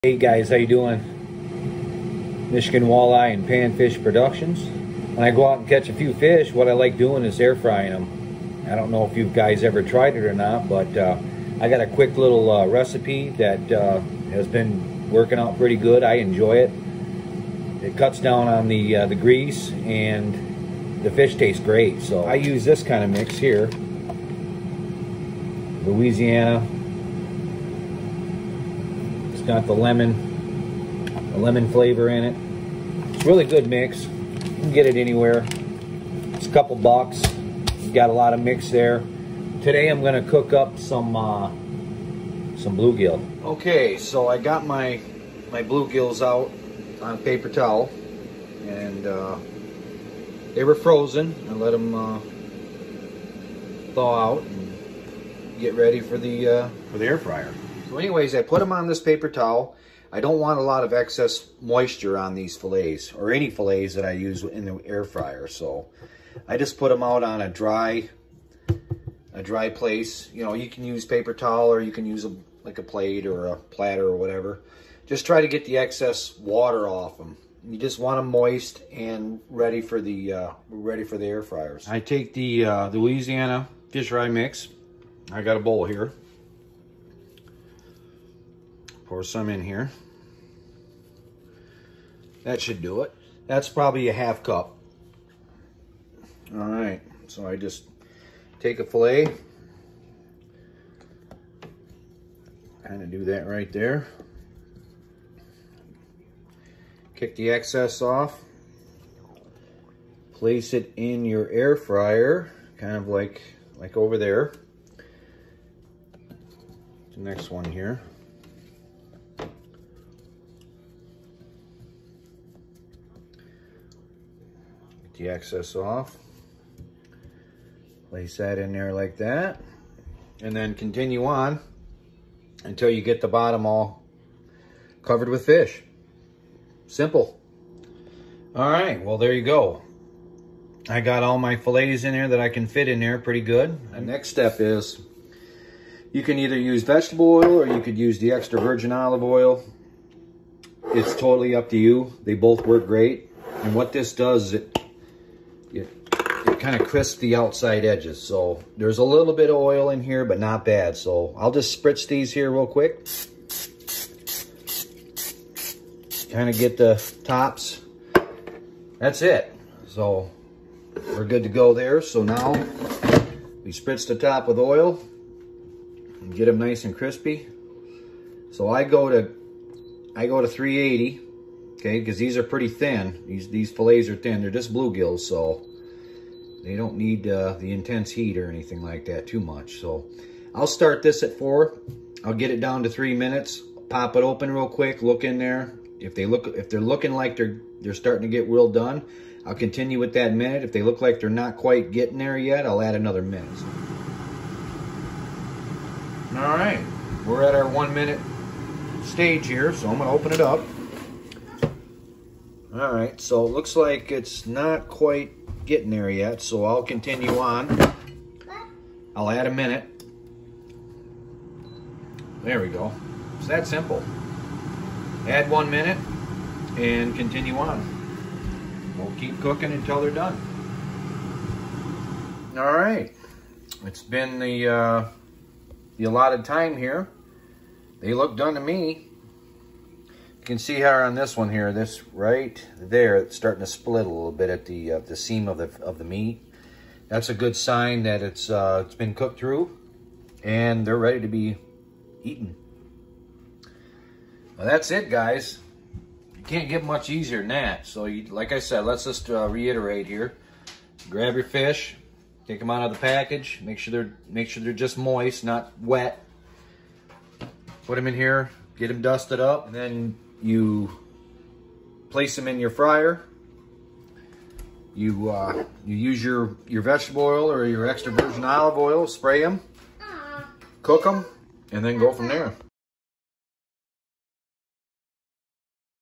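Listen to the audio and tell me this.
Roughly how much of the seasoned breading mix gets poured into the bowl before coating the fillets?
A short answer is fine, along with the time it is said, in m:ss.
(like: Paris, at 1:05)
Half cup, at 1:34.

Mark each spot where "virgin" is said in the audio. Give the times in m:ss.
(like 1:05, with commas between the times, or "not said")
2:28, 4:38.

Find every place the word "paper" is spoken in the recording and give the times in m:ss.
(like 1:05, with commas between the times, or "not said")
0:47, 0:59, 1:11.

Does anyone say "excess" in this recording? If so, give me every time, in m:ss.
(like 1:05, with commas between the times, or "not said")
1:00, 1:15, 1:47, 2:05.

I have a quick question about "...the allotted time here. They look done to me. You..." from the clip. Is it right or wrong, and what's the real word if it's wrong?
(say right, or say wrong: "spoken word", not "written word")
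right.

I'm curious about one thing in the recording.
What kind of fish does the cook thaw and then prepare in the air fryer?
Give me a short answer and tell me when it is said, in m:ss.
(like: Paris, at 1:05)
Bluegill, at 0:42.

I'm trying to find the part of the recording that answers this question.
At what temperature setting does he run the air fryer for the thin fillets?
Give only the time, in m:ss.
3:00.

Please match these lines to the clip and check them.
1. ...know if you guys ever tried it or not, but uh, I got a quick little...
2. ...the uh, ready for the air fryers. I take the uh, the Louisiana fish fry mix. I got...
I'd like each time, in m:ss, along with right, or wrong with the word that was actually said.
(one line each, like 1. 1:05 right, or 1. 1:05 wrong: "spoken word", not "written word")
1. 0:08 right
2. 1:19 right.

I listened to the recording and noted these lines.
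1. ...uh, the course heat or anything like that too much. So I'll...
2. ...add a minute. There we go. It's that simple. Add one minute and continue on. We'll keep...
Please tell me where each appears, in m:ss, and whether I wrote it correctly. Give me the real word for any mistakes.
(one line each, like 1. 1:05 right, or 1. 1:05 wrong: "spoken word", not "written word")
1. 3:07 wrong: "intense", not "course"
2. 3:39 right.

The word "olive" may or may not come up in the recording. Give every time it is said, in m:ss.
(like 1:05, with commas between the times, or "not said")
2:28, 4:38.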